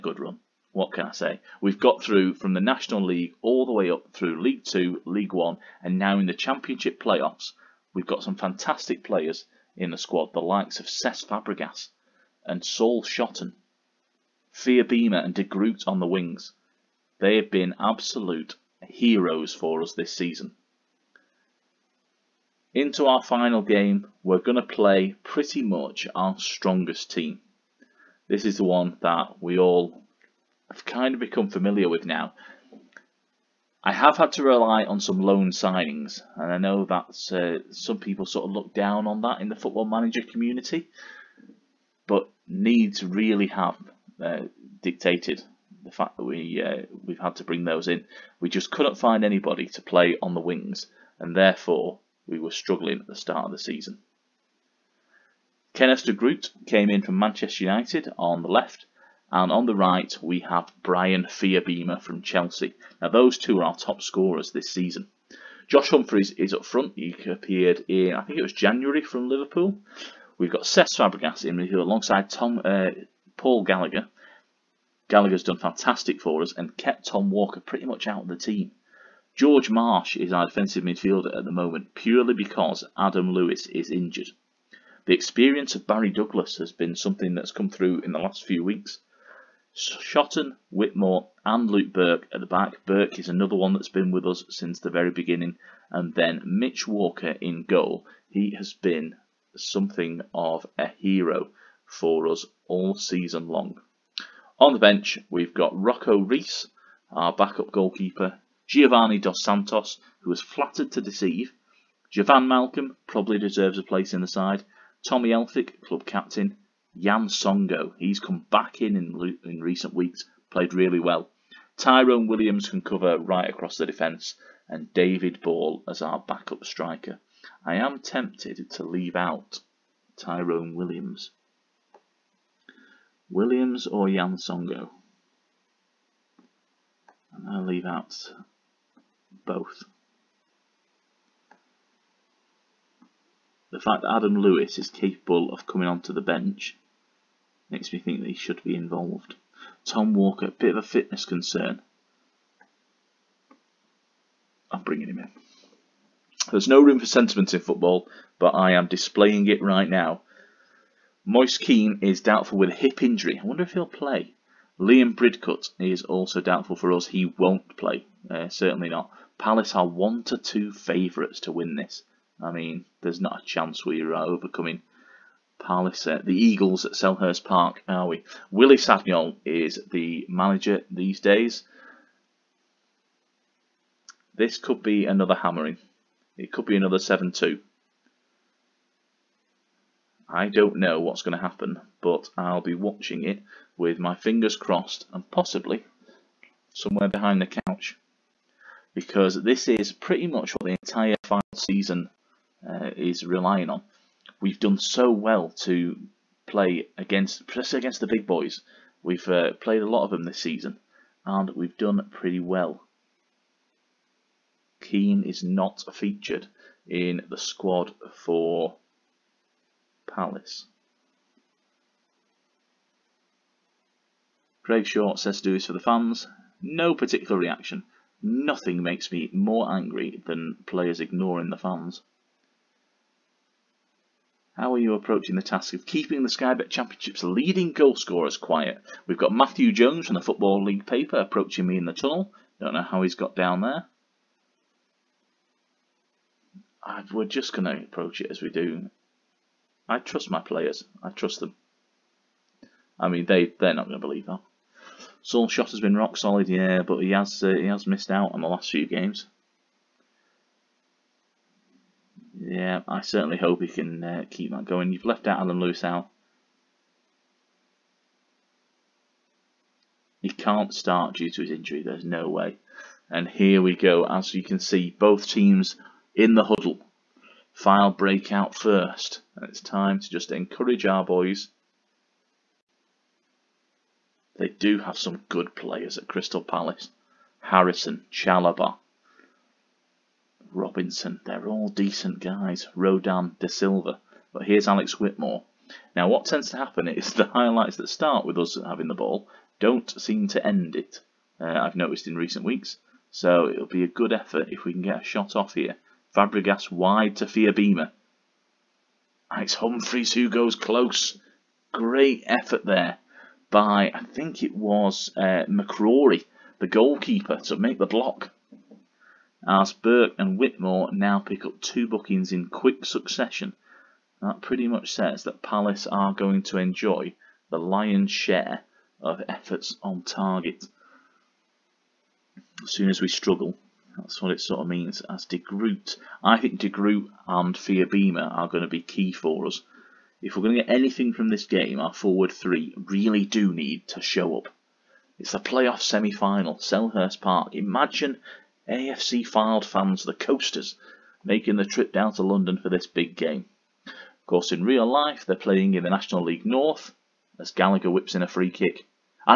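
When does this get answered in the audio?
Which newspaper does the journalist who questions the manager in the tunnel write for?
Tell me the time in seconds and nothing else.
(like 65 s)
240 s.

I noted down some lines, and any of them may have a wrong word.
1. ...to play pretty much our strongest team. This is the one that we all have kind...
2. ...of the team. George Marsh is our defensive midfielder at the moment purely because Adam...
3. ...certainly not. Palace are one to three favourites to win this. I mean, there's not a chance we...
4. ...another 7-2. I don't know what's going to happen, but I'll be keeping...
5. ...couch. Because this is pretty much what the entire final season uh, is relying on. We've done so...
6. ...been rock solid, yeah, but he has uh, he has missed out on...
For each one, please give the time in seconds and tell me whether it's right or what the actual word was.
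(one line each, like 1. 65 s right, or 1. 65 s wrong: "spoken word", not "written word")
1. 24 s right
2. 78 s right
3. 168 s wrong: "two", not "three"
4. 186 s wrong: "watching", not "keeping"
5. 197 s right
6. 255 s right.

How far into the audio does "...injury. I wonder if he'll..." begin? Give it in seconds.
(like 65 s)
163 s.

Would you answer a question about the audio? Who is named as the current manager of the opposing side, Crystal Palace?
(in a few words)
Willie Sagnol.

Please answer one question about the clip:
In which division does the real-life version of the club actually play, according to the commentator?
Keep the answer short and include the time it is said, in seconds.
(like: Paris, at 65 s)
National League North, at 355 s.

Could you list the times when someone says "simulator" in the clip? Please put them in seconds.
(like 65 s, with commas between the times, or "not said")
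not said.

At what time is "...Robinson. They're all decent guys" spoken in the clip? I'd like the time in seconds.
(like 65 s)
290 s.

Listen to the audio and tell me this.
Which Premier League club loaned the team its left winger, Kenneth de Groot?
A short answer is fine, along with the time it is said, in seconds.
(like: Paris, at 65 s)
Manchester United, at 57 s.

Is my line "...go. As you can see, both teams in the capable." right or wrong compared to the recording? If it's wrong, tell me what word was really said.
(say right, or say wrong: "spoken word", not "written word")
wrong: "huddle", not "capable".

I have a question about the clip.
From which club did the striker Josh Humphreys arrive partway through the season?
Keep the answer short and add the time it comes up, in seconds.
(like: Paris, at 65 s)
Liverpool, at 69 s.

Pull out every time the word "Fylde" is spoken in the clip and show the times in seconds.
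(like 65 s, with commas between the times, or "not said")
277 s, 349 s.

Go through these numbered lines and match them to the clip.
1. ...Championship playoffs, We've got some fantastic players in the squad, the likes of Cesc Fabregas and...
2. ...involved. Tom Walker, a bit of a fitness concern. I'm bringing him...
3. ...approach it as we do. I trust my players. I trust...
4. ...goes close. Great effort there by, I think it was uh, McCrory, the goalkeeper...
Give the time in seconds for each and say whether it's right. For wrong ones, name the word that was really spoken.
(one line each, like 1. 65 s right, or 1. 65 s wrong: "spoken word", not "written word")
1. 6 s right
2. 148 s right
3. 247 s right
4. 310 s right.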